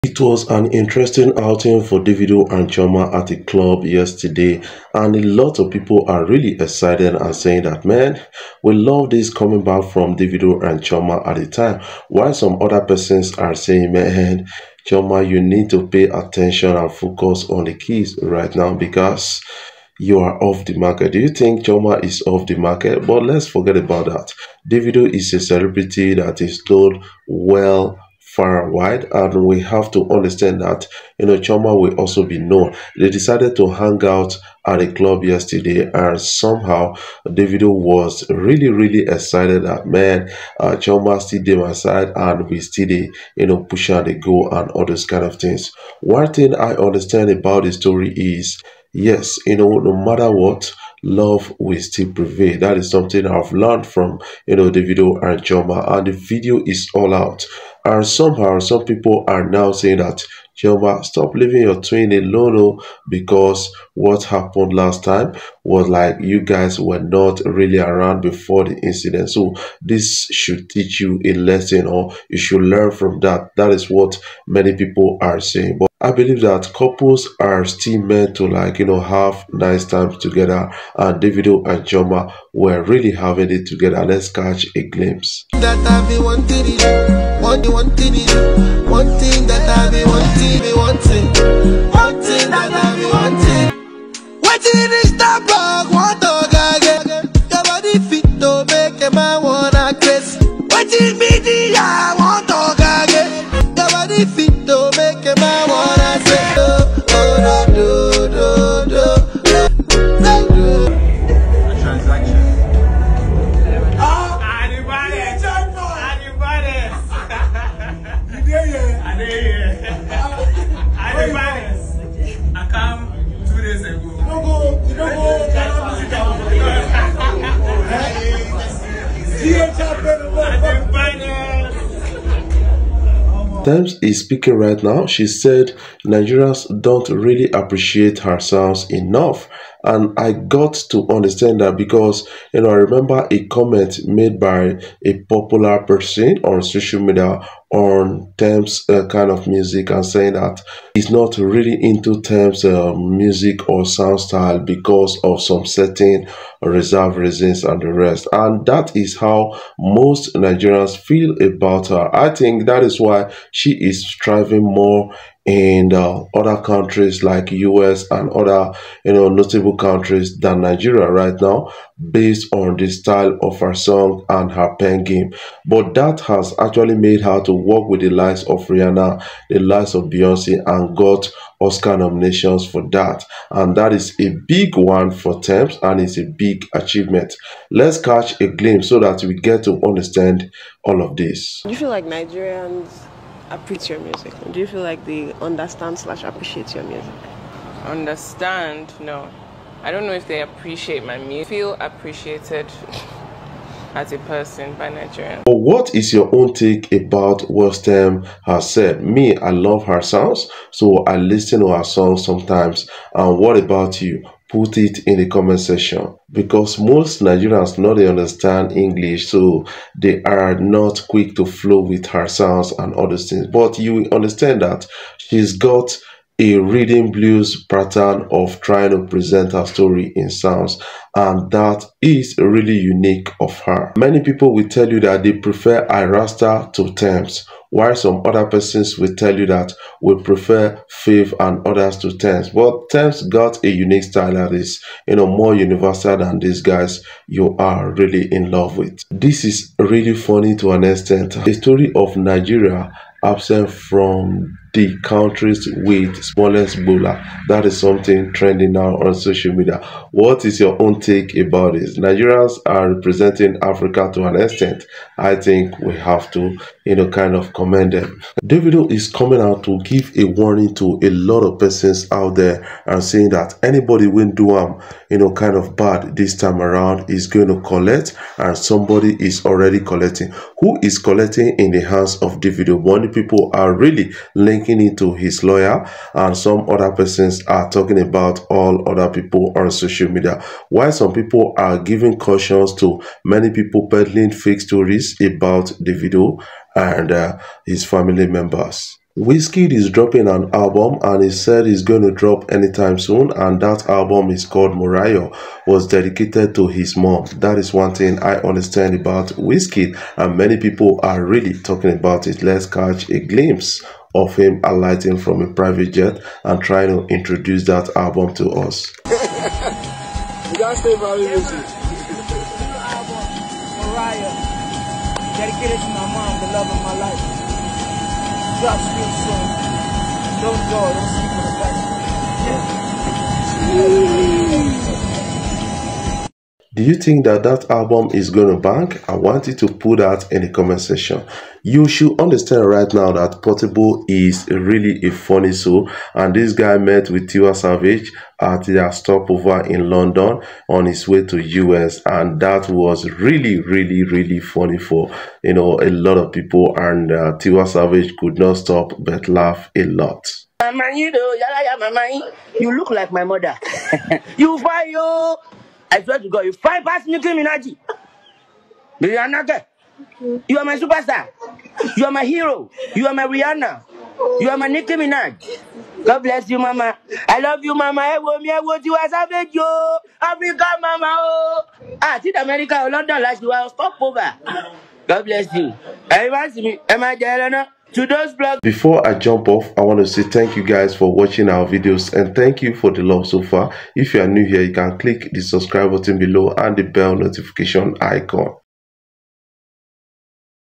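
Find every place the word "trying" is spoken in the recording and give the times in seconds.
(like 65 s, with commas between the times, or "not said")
228 s, 316 s.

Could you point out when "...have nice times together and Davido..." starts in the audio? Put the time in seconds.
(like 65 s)
78 s.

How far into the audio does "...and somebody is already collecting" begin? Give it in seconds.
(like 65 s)
278 s.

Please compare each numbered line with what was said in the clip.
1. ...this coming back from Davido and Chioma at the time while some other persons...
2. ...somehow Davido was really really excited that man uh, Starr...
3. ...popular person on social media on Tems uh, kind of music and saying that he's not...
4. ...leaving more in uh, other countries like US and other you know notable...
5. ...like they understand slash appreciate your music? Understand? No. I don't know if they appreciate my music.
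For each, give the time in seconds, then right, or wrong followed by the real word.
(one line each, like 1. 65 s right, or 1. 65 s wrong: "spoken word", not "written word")
1. 9 s right
2. 36 s wrong: "Chioma", not "Starr"
3. 145 s right
4. 164 s wrong: "striving", not "leaving"
5. 194 s right.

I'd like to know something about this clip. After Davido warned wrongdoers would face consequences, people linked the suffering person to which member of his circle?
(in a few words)
His lawyer.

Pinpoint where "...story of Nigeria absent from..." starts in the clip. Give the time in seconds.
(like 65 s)
251 s.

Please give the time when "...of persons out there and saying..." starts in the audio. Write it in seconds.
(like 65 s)
271 s.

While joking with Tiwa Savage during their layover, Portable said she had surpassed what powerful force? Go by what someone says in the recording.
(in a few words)
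Nuclear energy.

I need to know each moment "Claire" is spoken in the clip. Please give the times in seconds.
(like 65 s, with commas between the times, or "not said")
not said.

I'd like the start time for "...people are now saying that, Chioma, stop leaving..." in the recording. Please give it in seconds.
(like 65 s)
58 s.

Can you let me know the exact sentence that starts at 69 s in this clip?
So this should teach you a lesson or you should learn from that.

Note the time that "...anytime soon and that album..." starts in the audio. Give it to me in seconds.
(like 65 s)
302 s.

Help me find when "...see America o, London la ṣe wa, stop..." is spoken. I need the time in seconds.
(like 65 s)
382 s.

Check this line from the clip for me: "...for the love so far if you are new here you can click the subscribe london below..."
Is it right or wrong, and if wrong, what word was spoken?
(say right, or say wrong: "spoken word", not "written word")
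wrong: "button", not "london".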